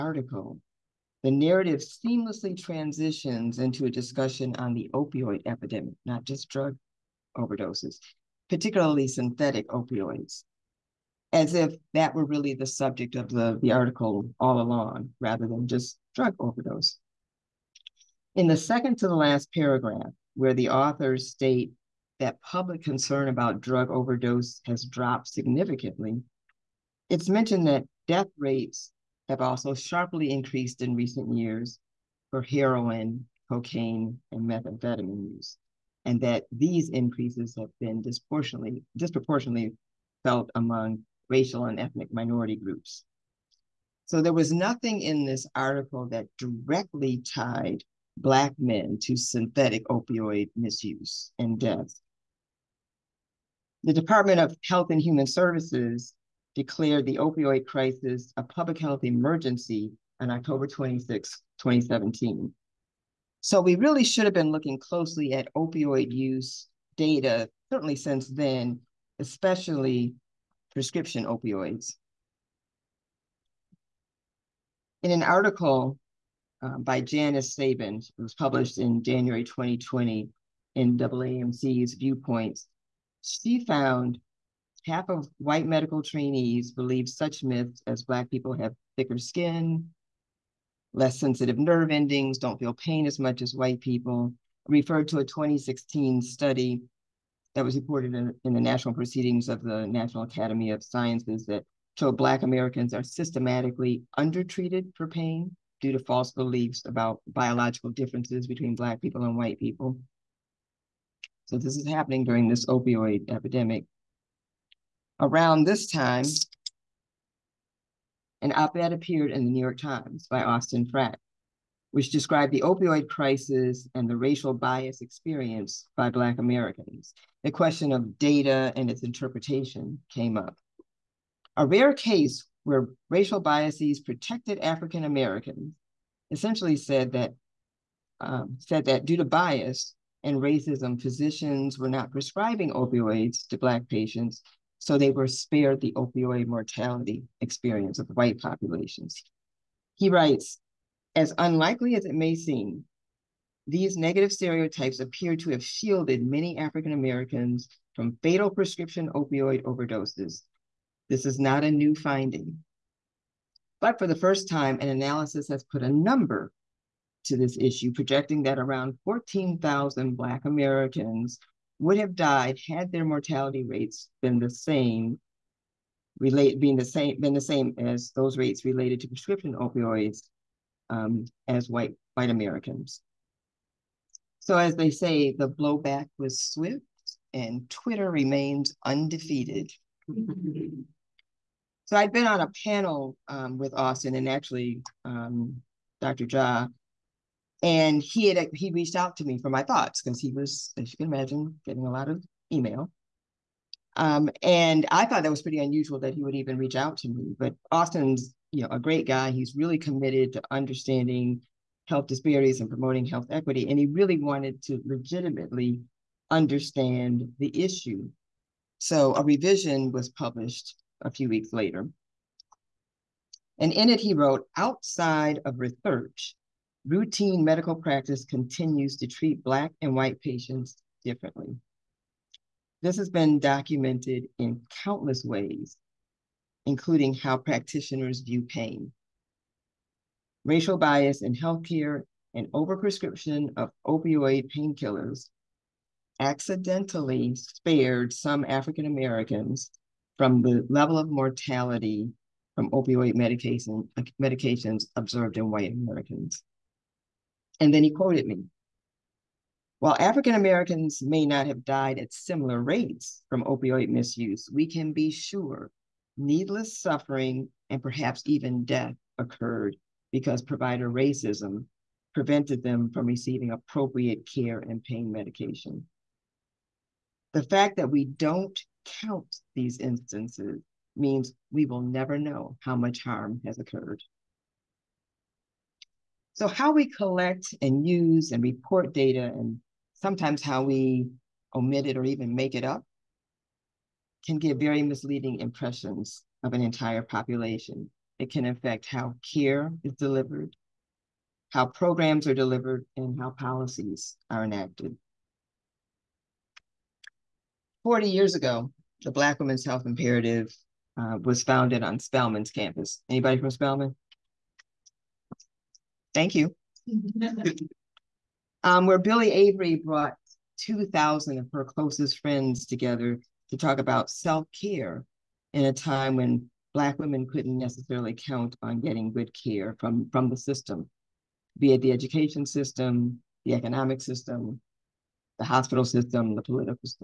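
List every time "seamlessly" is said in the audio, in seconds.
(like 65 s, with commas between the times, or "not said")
1 s.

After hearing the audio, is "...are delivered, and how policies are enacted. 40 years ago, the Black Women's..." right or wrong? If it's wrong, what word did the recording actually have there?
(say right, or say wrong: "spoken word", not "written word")
right.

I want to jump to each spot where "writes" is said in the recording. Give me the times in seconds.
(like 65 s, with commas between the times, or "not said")
150 s.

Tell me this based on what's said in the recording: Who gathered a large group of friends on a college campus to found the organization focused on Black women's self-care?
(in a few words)
Byllye Avery.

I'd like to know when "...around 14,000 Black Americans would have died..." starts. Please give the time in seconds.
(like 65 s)
168 s.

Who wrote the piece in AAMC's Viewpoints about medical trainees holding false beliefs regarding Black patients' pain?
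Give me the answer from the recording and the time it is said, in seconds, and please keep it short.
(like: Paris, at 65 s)
Janice Sabin, at 76 s.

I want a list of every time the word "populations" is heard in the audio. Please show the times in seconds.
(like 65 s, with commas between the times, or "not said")
148 s, 297 s.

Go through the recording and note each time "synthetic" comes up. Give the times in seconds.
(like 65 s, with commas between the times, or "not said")
9 s, 49 s.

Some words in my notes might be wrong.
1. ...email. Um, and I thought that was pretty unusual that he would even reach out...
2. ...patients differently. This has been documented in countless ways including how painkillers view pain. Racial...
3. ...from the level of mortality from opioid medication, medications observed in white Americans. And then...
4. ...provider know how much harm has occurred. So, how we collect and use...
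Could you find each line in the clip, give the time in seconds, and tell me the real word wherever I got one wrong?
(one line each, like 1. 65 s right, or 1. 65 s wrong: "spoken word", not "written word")
1. 202 s right
2. 230 s wrong: "practitioners", not "painkillers"
3. 250 s right
4. 281 s wrong: "never", not "provider".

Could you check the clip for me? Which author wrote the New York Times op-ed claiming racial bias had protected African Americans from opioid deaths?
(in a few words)
Austin Frakt.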